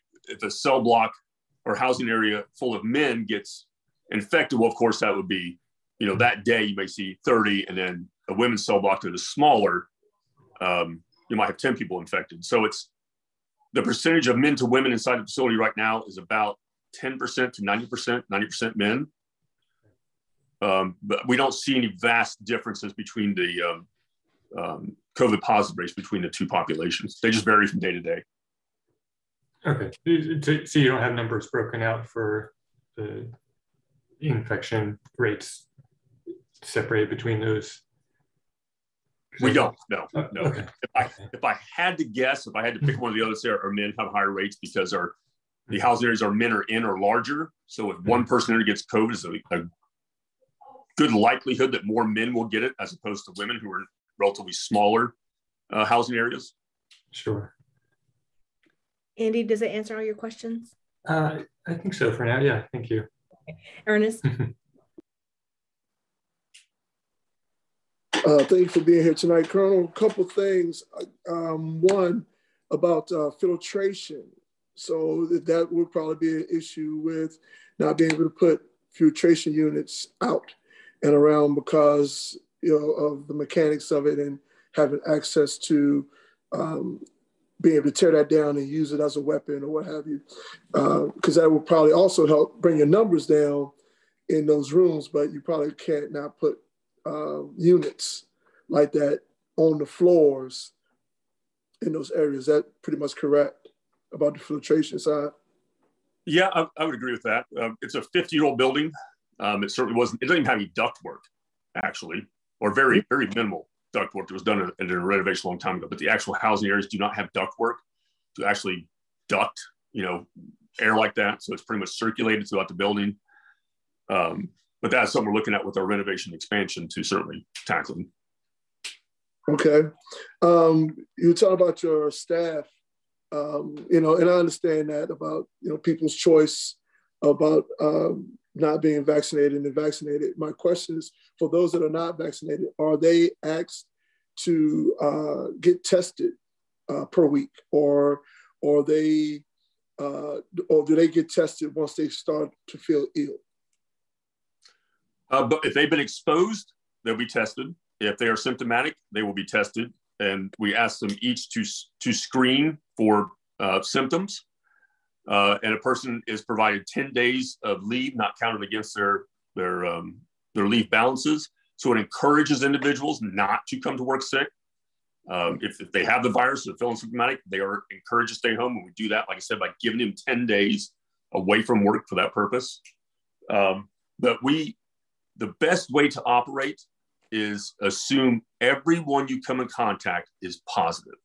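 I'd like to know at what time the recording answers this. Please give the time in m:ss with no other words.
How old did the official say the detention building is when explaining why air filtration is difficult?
1:48.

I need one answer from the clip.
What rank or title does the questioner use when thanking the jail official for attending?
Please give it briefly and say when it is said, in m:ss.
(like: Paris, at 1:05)
Colonel, at 1:09.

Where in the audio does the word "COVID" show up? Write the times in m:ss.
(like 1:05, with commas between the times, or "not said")
0:25, 0:48.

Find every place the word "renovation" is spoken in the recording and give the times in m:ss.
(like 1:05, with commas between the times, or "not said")
1:54, 2:05.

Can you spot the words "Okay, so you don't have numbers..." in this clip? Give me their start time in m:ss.
0:29.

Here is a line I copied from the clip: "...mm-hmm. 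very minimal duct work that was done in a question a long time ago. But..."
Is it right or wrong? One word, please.
wrong.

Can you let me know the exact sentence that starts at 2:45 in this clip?
Uh, and a person is provided 10 days of leave, not counted against their, their, um, their leave balances.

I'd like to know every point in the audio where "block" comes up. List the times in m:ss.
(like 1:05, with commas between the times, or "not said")
0:00, 0:08.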